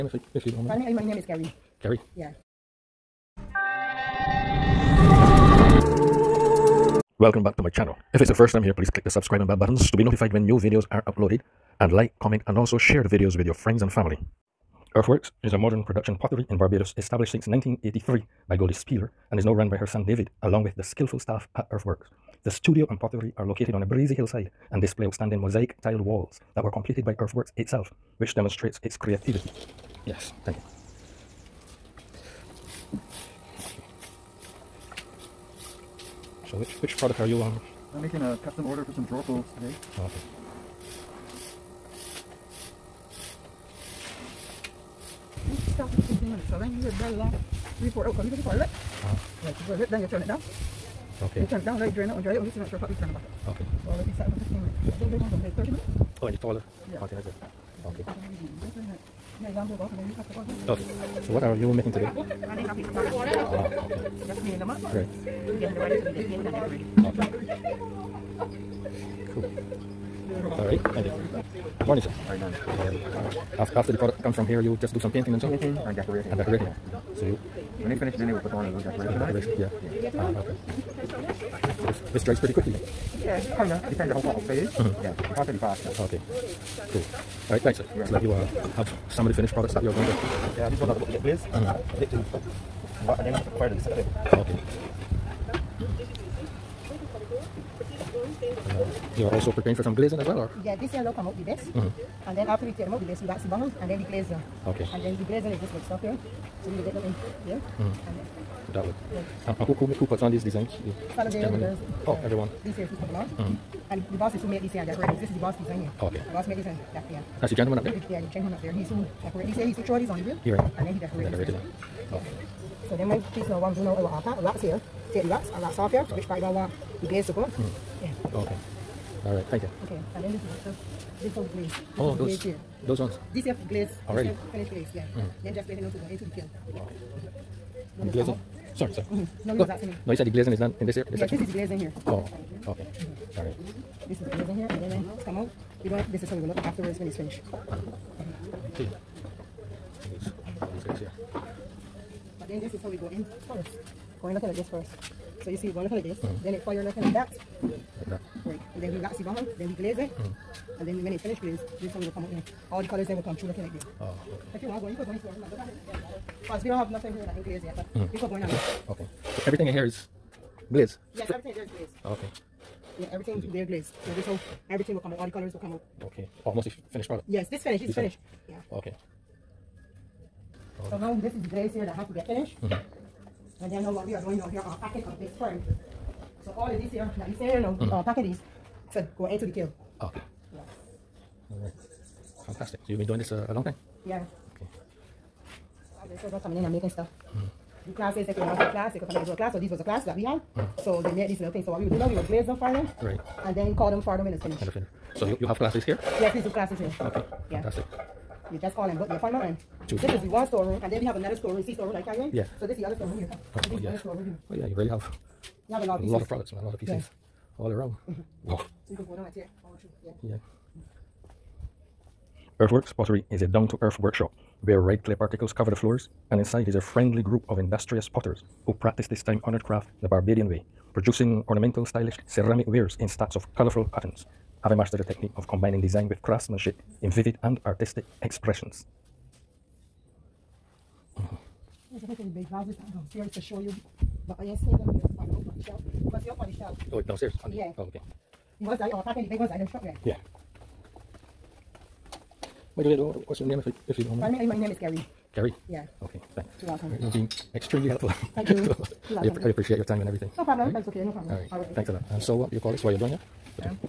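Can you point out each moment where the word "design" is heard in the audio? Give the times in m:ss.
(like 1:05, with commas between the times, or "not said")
1:50, 1:55, 3:55.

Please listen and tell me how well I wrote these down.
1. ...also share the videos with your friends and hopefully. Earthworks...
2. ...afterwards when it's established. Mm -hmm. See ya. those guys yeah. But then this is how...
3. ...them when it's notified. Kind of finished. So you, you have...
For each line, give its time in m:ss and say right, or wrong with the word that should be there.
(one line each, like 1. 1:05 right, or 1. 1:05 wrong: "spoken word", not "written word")
1. 0:12 wrong: "family", not "hopefully"
2. 2:26 wrong: "finished", not "established"
3. 3:24 wrong: "finished", not "notified".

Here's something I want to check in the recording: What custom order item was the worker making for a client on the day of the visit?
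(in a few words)
Drawer pulls.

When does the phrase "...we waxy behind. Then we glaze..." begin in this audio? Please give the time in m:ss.
2:38.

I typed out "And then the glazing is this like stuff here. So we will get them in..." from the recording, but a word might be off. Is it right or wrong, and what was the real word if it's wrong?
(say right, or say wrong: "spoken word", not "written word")
right.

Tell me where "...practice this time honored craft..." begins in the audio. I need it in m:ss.
3:48.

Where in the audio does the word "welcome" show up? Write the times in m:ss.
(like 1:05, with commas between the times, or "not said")
0:07, 4:16.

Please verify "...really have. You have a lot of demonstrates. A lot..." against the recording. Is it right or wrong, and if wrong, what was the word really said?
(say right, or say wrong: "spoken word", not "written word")
wrong: "pieces", not "demonstrates".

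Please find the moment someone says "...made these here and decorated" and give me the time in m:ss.
1:54.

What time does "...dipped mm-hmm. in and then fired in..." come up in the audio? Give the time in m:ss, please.
1:31.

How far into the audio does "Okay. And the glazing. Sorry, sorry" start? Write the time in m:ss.
2:16.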